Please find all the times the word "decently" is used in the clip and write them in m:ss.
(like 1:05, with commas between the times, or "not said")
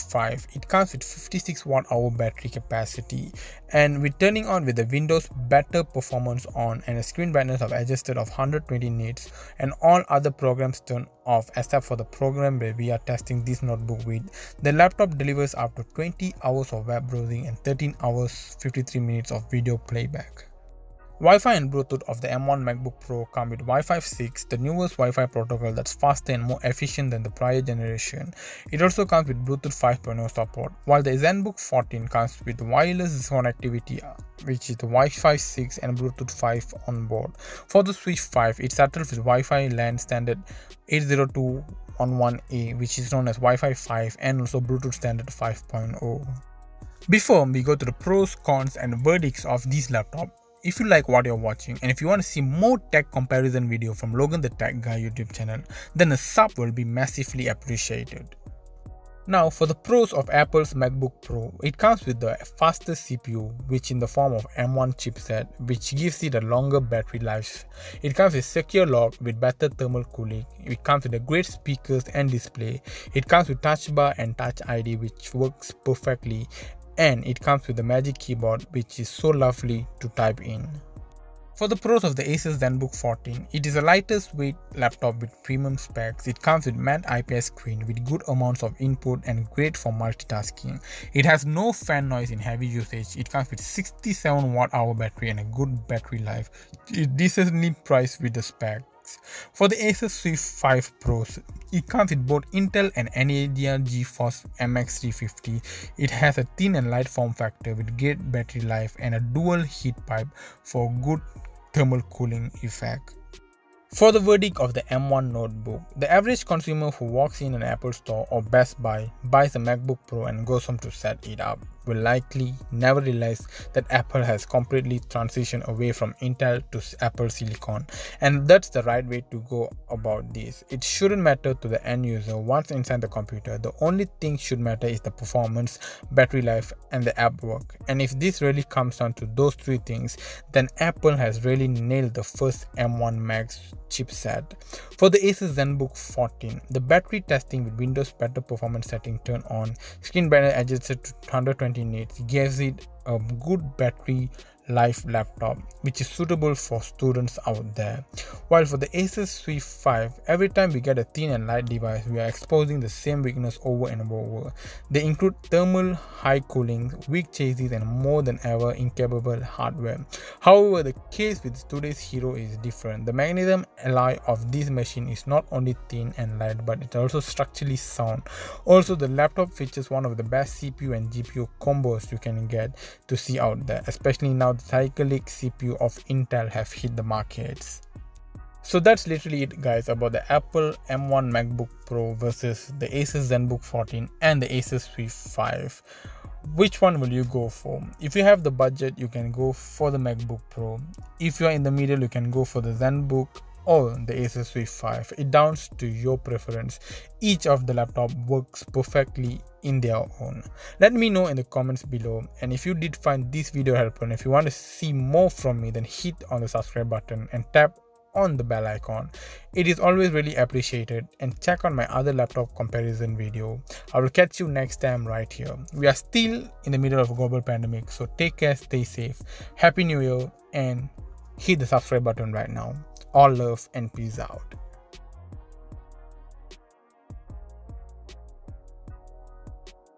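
1:37.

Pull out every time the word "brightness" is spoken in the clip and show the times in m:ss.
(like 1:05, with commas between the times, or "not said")
0:07, 2:30.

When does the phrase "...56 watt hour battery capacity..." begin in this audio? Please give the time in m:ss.
0:01.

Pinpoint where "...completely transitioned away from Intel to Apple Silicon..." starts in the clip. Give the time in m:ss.
2:04.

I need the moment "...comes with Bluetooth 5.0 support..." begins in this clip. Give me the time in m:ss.
0:29.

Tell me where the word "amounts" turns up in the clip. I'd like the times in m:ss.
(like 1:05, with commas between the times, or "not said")
1:28.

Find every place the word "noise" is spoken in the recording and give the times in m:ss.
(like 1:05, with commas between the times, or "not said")
1:32.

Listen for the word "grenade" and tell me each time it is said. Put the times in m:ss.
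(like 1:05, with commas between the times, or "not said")
not said.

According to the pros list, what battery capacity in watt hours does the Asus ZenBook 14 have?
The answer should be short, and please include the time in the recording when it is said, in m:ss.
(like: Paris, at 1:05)
67 watt hour, at 1:33.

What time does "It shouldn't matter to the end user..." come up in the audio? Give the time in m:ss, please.
2:10.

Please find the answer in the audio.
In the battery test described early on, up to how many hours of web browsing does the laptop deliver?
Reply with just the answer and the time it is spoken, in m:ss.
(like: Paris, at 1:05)
20 hours, at 0:15.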